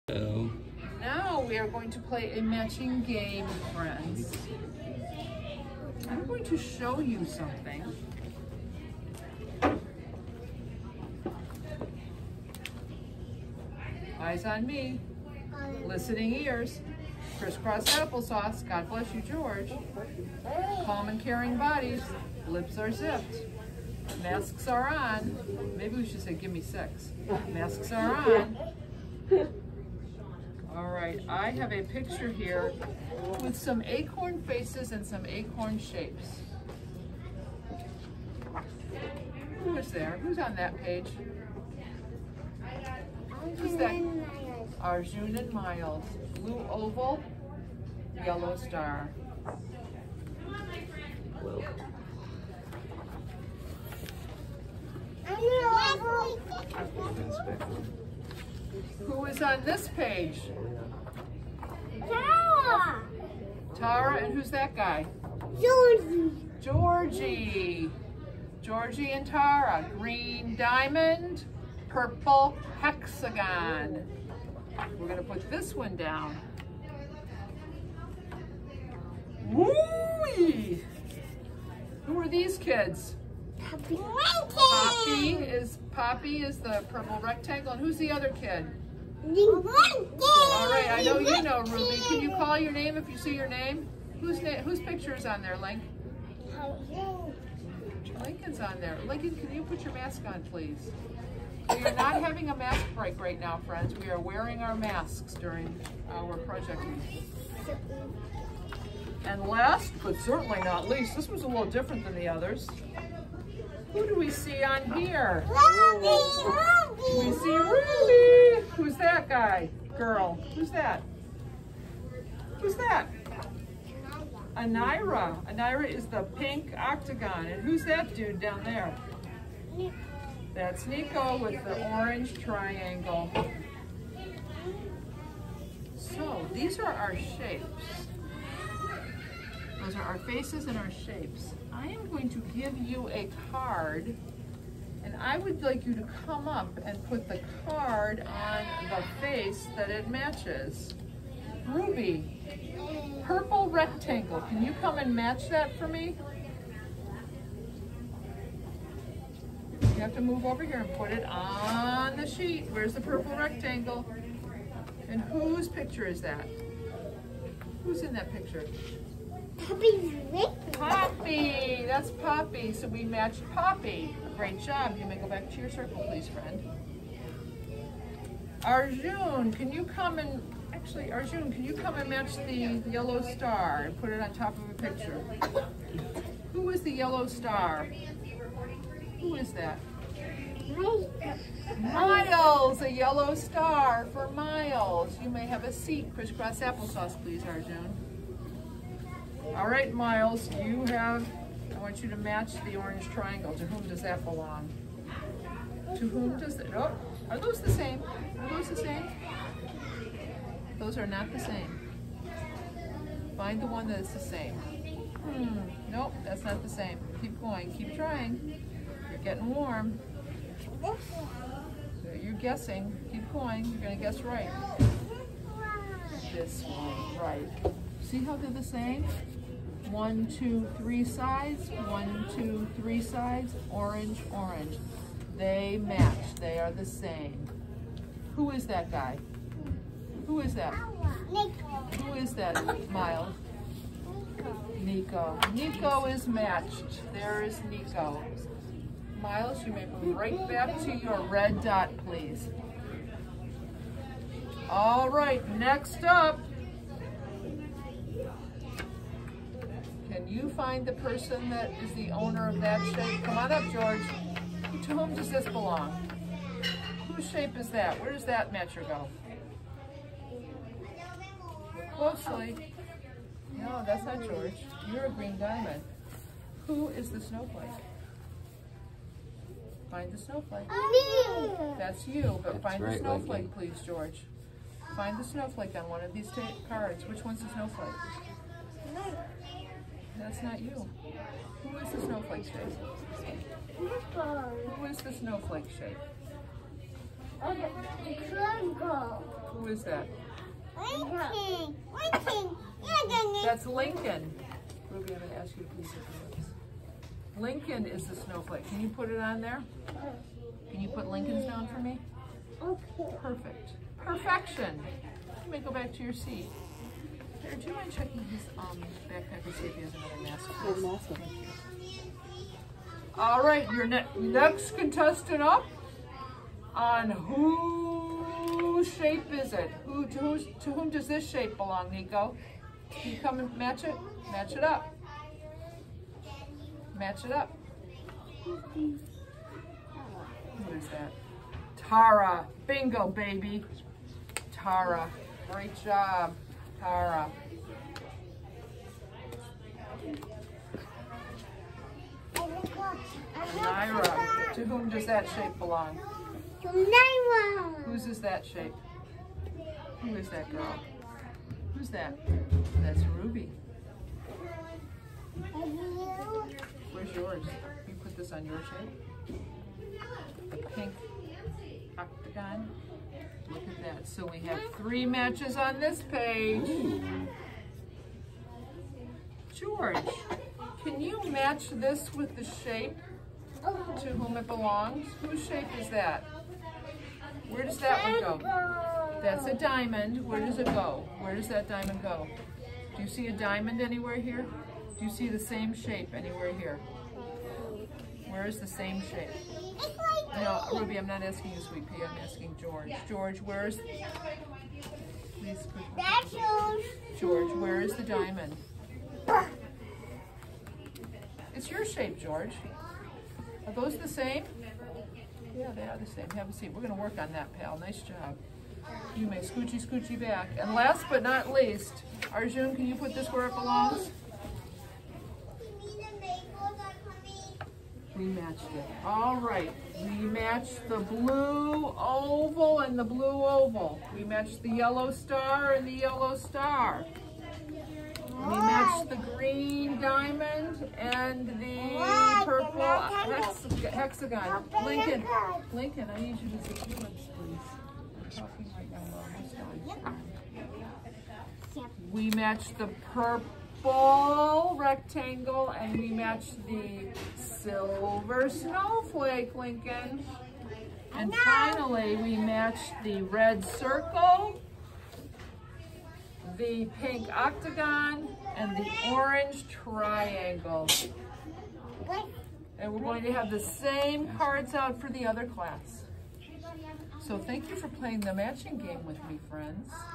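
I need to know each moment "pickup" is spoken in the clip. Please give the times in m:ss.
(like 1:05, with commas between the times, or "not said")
not said.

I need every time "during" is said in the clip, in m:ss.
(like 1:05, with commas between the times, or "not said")
1:45.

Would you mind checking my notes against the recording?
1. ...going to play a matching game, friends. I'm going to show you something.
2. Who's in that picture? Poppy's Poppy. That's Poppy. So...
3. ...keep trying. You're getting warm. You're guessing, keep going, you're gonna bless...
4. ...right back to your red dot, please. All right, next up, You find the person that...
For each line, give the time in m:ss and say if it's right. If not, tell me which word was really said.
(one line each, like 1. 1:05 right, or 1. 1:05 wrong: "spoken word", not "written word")
1. 0:01 right
2. 2:47 right
3. 3:37 wrong: "guess", not "bless"
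4. 4:10 right.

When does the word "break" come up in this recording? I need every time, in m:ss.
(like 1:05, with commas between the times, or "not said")
1:42.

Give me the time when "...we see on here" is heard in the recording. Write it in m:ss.
1:54.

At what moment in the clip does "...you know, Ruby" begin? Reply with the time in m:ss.
1:31.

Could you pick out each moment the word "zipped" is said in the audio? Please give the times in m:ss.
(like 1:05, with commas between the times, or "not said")
0:22.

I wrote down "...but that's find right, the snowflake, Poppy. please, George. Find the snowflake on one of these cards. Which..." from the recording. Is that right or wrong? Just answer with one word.
wrong.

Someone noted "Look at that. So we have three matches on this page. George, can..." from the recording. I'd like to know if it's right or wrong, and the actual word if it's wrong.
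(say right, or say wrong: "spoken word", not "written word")
right.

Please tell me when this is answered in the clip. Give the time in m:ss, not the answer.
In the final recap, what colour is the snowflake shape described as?
7:37.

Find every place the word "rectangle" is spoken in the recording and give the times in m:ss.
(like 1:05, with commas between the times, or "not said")
1:27, 2:33, 2:43, 7:34.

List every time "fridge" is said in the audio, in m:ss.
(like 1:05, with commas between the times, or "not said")
not said.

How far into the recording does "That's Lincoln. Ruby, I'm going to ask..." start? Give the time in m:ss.
5:03.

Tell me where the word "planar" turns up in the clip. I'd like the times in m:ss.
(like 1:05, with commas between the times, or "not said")
not said.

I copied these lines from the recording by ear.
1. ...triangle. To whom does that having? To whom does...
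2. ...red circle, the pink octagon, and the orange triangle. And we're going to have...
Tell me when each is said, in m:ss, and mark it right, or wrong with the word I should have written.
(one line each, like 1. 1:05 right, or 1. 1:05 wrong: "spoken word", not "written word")
1. 3:23 wrong: "belong", not "having"
2. 7:43 right.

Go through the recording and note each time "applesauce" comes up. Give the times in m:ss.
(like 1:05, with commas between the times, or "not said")
0:17, 3:16.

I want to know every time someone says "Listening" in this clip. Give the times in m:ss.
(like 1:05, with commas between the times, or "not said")
0:15.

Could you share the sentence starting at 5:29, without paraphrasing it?
Who to, who's, to whom does this shape belong, Nico?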